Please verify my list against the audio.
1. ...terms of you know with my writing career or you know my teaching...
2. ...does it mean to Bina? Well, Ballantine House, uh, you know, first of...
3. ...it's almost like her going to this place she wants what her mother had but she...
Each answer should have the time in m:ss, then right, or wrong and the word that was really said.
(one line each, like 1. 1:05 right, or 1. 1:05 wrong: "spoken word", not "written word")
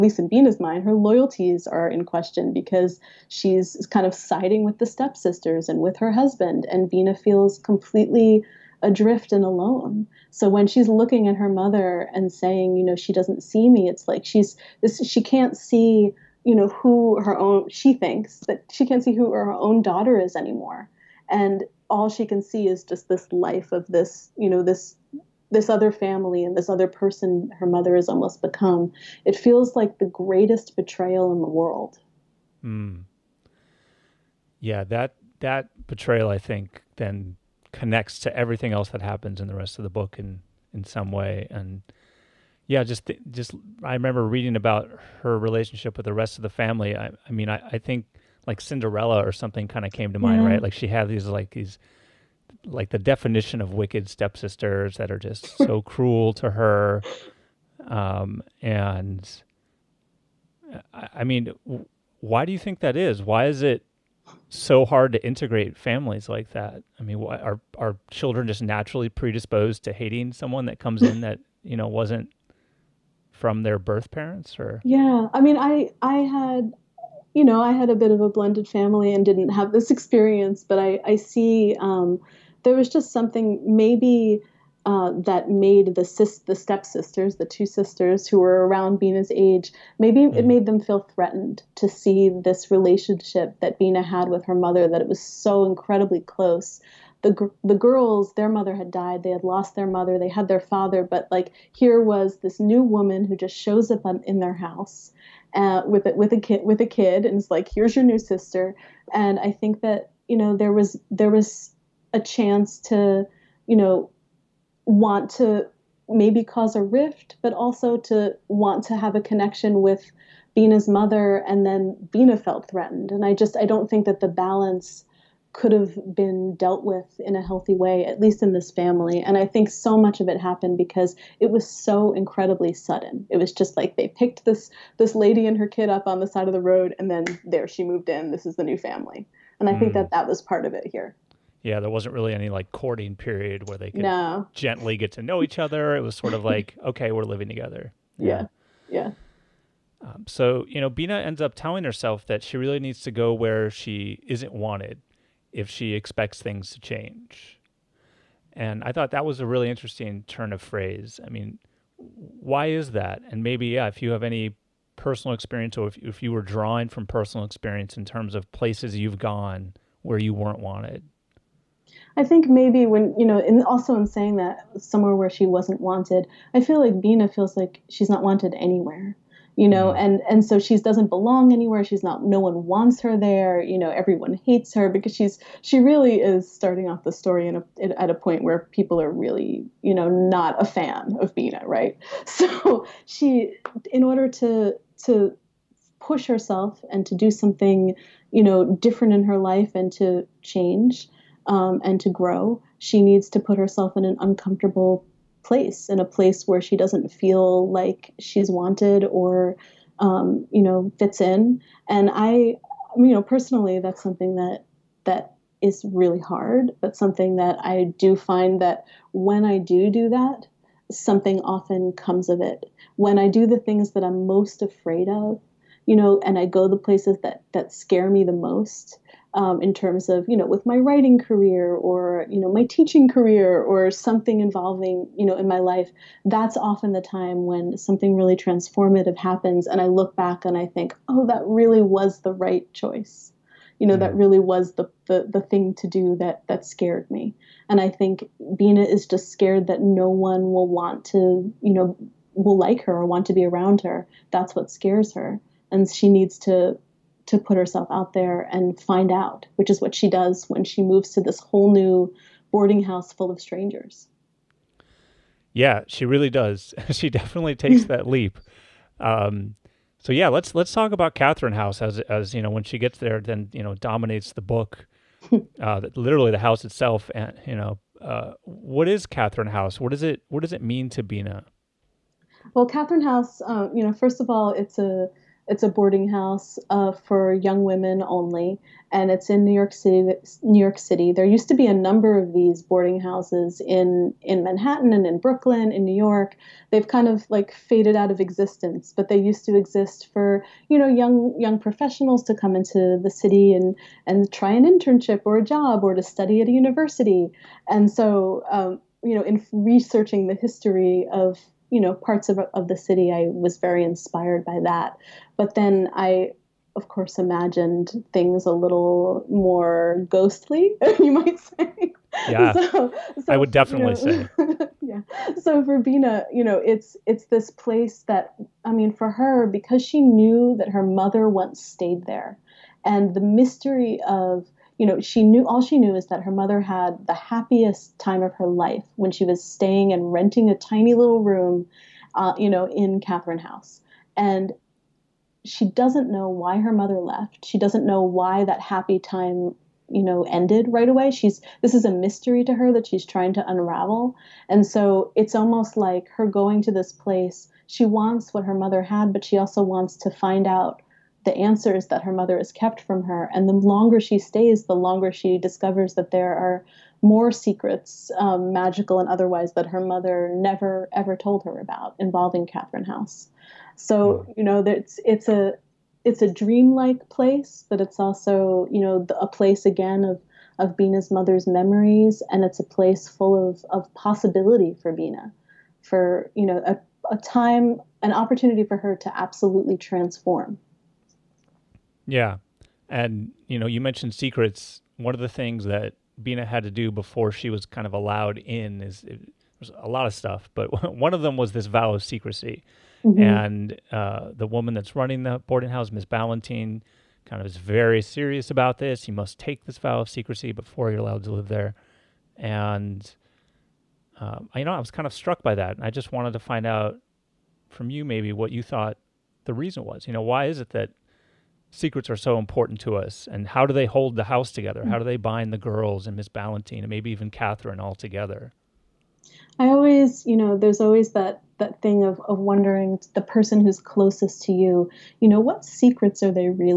1. 3:49 right
2. 4:40 wrong: "Catherine", not "Ballantine"
3. 5:55 right.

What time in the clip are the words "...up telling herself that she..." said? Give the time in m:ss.
2:31.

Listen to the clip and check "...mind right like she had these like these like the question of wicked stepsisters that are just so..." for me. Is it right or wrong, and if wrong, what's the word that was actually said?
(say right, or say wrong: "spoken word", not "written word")
wrong: "definition", not "question".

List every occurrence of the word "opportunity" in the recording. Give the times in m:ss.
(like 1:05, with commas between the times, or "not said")
6:28.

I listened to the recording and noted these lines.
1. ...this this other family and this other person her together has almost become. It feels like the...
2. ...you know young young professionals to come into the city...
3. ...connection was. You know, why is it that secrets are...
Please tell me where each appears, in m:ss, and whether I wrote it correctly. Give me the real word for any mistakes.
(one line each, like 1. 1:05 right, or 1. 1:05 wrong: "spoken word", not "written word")
1. 0:24 wrong: "mother", not "together"
2. 5:00 right
3. 6:59 wrong: "reason", not "connection".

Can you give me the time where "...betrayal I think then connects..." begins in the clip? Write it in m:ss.
0:35.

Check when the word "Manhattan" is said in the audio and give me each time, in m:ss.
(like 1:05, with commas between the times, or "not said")
4:54.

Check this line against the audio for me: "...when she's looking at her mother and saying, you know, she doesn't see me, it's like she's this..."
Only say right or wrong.
right.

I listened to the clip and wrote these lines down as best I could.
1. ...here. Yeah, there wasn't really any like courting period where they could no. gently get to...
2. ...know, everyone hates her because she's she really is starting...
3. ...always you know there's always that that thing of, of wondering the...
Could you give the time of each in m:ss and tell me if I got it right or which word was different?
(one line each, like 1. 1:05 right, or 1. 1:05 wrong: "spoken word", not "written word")
1. 2:20 right
2. 3:03 right
3. 7:09 right.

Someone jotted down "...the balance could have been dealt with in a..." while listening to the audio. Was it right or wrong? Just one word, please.
right.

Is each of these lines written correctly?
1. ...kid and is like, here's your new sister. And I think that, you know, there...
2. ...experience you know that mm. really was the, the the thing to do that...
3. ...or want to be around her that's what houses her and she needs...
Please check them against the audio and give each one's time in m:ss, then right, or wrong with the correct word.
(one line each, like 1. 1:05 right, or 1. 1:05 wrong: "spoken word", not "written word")
1. 1:46 right
2. 4:02 wrong: "choice", not "experience"
3. 4:12 wrong: "scares", not "houses".